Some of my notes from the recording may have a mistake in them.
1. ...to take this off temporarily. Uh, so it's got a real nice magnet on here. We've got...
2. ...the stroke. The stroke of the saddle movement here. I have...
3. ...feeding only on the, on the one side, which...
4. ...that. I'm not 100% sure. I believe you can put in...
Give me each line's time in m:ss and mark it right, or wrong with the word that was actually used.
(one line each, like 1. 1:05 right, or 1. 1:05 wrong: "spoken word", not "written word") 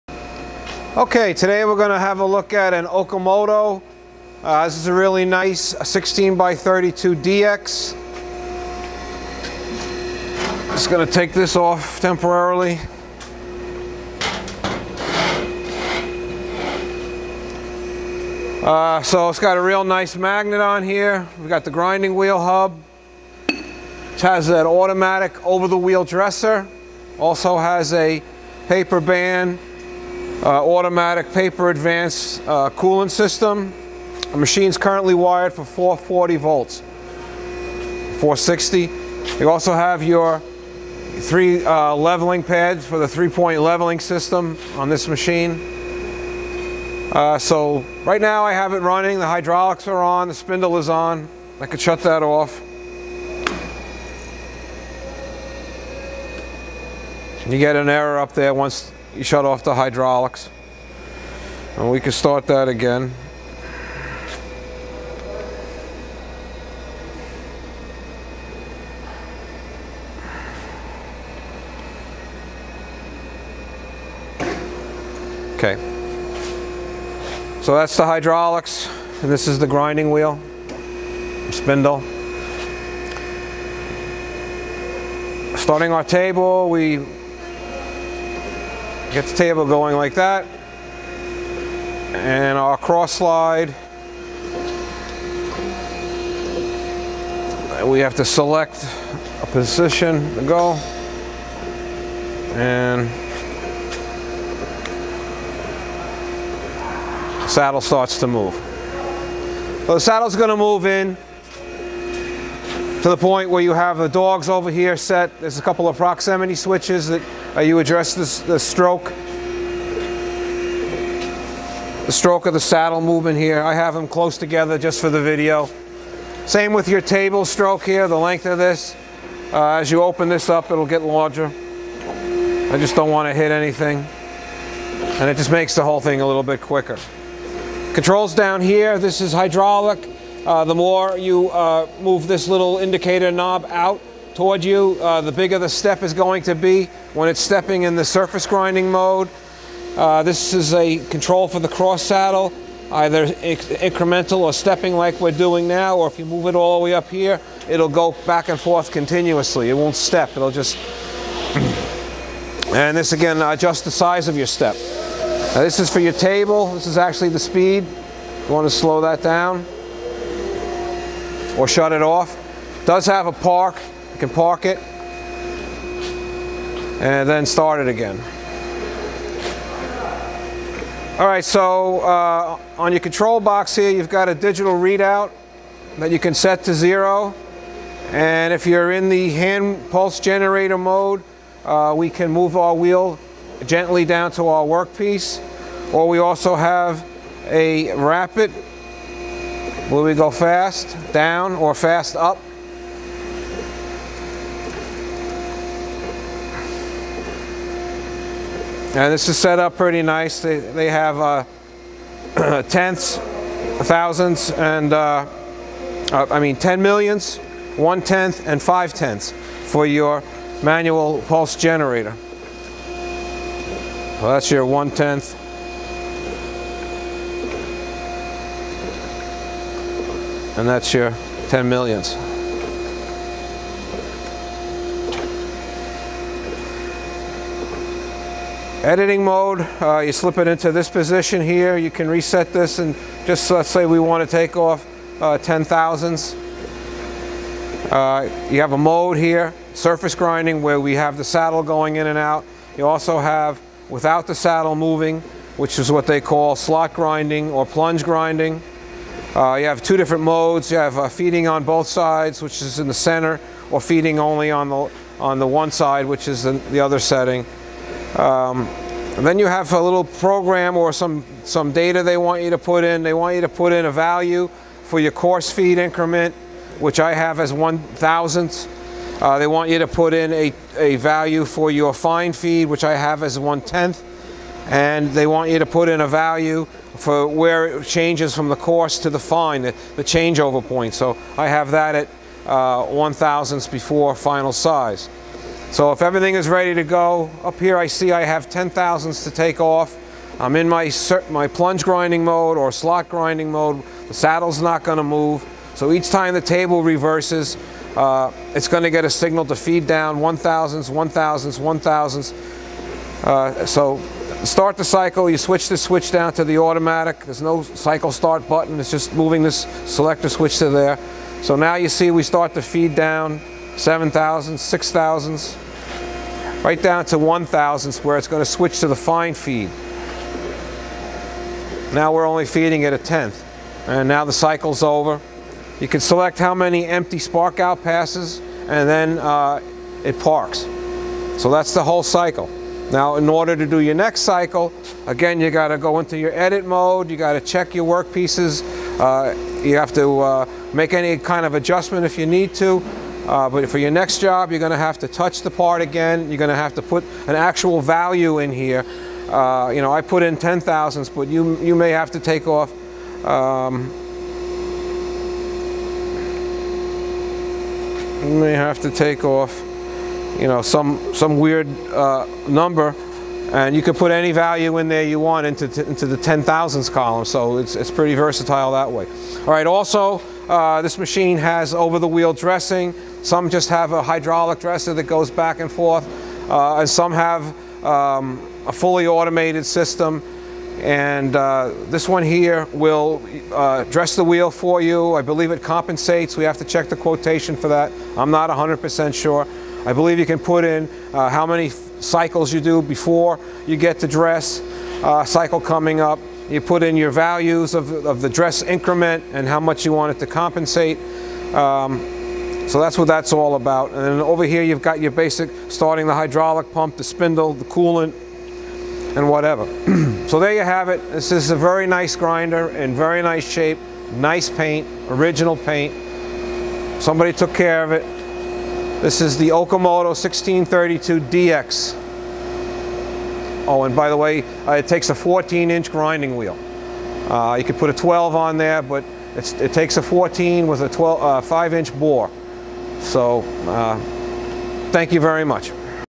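1. 0:11 right
2. 1:58 right
3. 4:23 right
4. 6:37 right.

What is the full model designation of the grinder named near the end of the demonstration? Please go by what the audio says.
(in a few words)
Okamoto 1632DX.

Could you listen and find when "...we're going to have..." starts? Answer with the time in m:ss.
0:01.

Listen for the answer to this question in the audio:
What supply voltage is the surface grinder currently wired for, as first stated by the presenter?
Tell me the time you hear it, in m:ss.
0:35.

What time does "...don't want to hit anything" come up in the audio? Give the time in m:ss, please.
2:12.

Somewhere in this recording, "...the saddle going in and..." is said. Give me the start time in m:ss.
4:11.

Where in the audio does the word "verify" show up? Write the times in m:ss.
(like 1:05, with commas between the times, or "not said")
not said.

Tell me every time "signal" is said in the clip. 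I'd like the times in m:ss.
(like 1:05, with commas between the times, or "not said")
5:09.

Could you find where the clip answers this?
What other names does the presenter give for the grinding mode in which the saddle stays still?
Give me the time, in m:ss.
4:16.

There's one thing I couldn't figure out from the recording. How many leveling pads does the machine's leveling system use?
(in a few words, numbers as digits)
3.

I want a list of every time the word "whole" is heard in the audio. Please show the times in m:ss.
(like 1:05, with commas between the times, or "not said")
2:15, 5:41.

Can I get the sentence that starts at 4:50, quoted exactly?
So I have that at uh, one thousandths before final size.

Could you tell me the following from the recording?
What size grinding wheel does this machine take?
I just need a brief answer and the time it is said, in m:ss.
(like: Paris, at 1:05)
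14-inch, at 7:15.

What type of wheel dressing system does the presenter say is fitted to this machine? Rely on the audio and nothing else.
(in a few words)
over-the-wheel dressing.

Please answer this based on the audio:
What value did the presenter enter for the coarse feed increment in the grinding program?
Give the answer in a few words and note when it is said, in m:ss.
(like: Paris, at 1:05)
1 thousandth, at 4:37.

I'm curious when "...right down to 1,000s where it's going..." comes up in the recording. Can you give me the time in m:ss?
5:26.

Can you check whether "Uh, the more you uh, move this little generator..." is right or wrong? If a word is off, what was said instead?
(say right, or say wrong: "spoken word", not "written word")
wrong: "indicator", not "generator".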